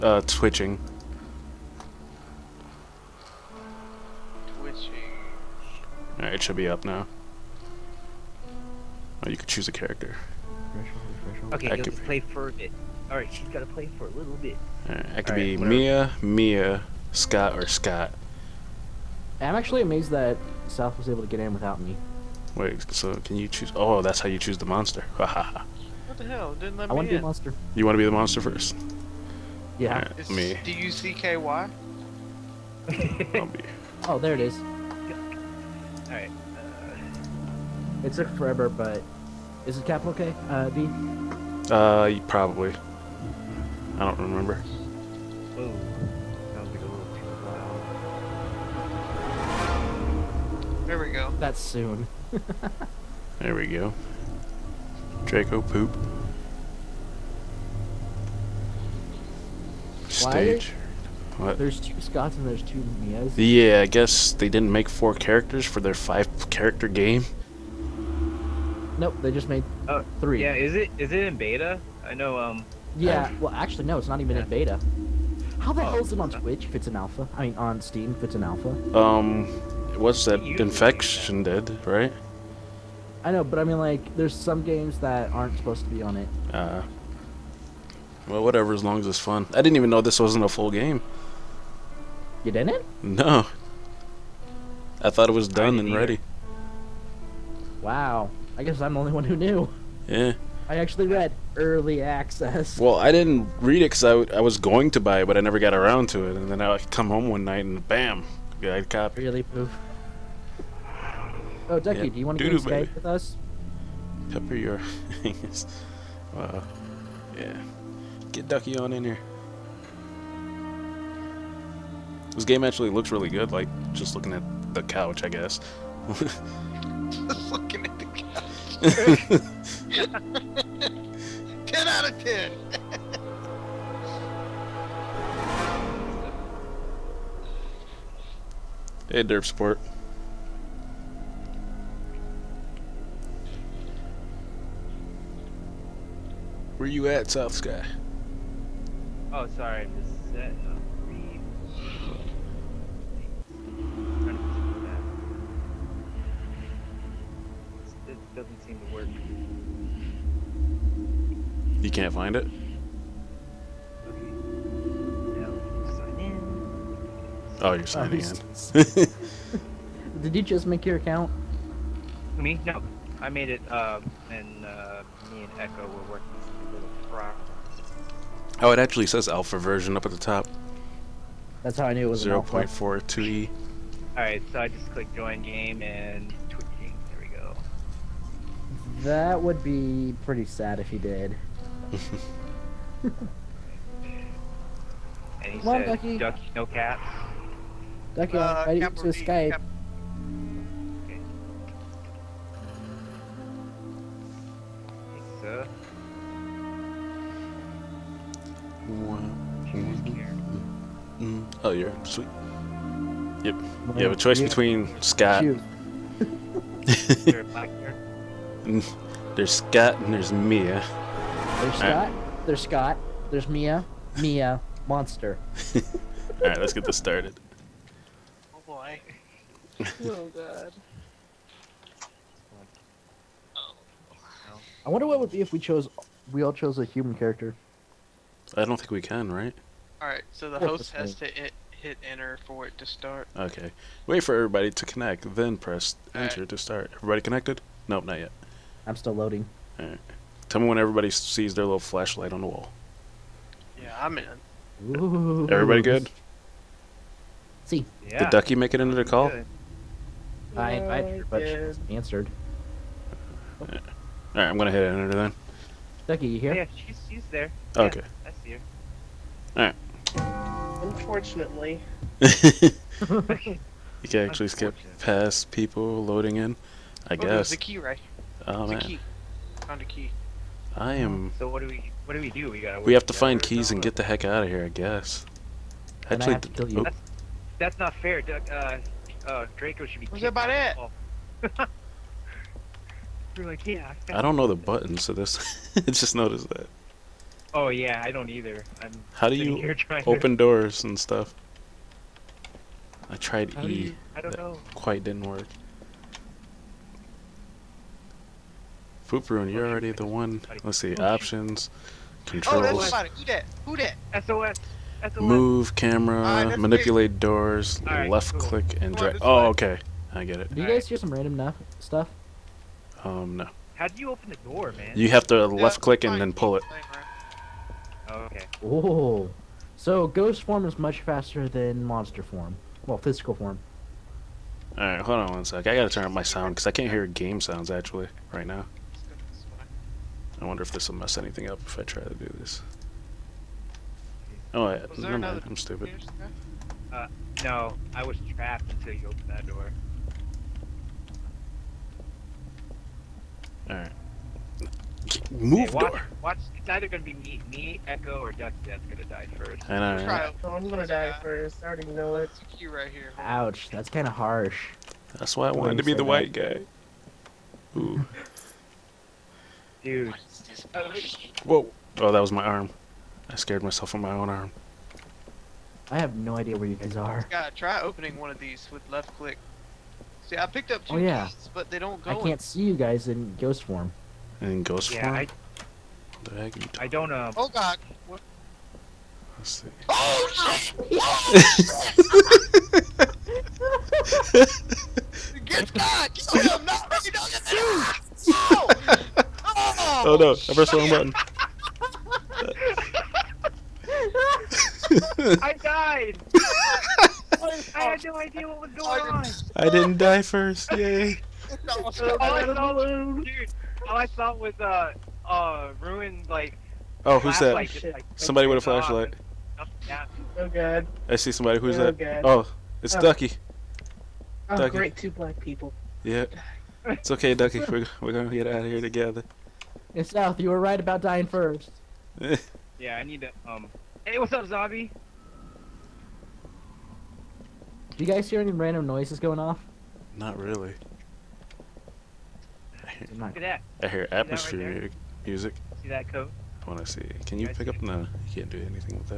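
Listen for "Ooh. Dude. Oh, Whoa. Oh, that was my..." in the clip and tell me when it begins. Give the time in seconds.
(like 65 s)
367 s.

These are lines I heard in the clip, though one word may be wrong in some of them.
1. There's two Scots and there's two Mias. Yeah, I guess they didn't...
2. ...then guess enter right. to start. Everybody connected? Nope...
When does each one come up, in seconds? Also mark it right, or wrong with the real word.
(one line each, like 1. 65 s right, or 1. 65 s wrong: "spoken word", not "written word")
1. 61 s right
2. 245 s wrong: "press", not "guess".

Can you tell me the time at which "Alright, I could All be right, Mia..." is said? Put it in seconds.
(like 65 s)
14 s.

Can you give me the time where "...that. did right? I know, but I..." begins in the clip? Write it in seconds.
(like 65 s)
81 s.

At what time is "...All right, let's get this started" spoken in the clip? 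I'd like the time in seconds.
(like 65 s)
225 s.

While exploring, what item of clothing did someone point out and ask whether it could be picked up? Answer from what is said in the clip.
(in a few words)
coat.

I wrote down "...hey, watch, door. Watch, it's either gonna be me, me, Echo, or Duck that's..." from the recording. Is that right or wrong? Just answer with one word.
right.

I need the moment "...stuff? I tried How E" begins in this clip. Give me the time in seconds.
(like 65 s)
300 s.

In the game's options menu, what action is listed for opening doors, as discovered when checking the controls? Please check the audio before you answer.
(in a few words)
click and drag.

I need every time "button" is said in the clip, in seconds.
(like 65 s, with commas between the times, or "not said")
294 s, 400 s.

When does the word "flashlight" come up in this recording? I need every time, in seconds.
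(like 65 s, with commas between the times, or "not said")
251 s, 418 s.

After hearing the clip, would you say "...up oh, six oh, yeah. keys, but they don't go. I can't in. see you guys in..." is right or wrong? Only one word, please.
wrong.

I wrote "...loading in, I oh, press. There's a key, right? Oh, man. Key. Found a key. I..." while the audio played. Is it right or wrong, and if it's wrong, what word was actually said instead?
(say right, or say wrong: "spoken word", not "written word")
wrong: "guess", not "press".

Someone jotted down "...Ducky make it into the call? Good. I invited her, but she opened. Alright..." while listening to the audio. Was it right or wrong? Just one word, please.
wrong.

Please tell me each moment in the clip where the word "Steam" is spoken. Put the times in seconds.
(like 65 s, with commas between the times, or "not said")
77 s.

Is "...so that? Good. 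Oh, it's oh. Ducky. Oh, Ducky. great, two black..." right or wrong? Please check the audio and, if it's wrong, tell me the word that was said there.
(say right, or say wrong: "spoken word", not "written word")
right.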